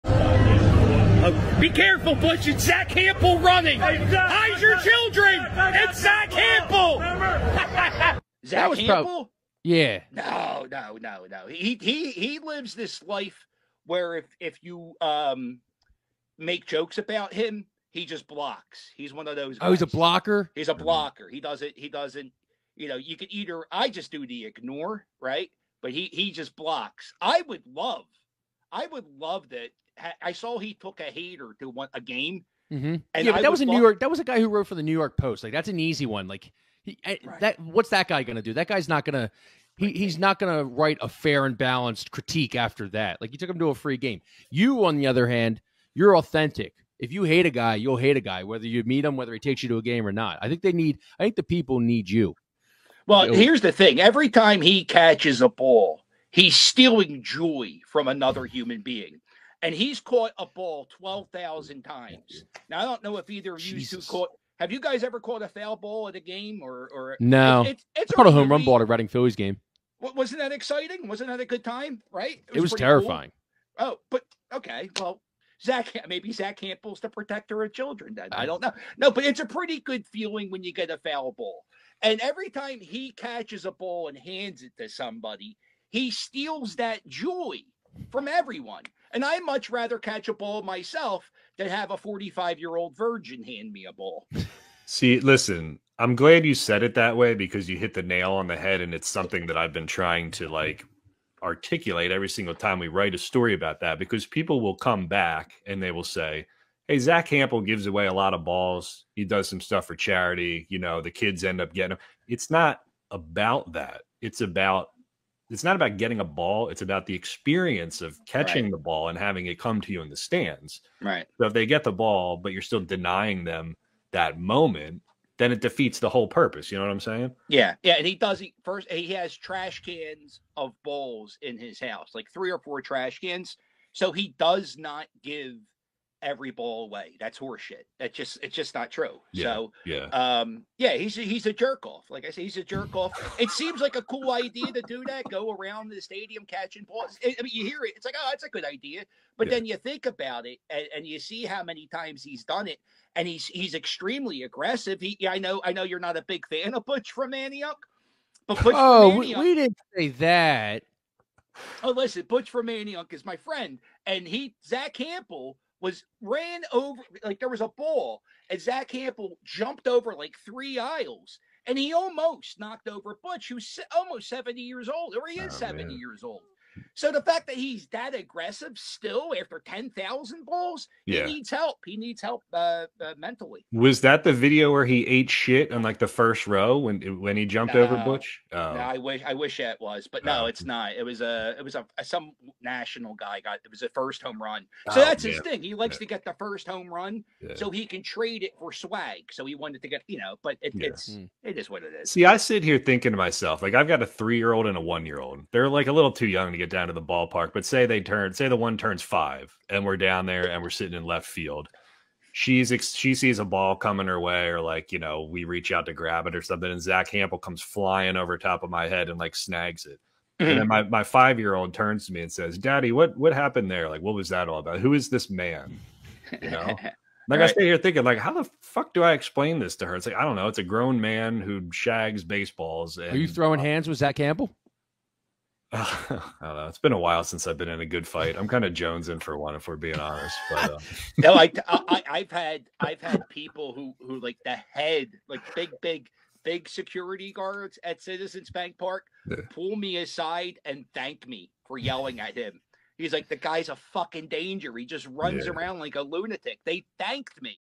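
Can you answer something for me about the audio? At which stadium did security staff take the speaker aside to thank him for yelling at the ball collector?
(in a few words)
Citizens Bank Park.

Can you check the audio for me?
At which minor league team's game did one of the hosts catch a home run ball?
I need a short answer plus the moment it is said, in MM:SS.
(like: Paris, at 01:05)
Reading Phillies, at 01:08.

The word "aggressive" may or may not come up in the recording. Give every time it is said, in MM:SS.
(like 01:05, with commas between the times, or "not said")
02:34, 02:58.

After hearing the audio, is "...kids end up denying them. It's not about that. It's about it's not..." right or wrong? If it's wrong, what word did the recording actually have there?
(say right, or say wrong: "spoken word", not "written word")
wrong: "getting", not "denying".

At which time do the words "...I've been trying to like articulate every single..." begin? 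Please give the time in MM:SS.
01:39.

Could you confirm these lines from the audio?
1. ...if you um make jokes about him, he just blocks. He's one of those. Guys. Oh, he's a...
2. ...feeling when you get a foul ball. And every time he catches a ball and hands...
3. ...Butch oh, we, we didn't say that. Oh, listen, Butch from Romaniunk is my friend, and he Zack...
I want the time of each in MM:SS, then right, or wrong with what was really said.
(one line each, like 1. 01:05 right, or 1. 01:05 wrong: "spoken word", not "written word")
1. 00:14 right
2. 01:20 right
3. 02:38 right.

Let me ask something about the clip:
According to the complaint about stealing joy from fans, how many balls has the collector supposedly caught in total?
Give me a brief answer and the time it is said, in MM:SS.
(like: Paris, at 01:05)
12,000, at 01:00.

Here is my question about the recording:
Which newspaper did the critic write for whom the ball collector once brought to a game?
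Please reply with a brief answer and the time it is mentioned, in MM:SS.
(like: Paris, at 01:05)
New York Post, at 00:34.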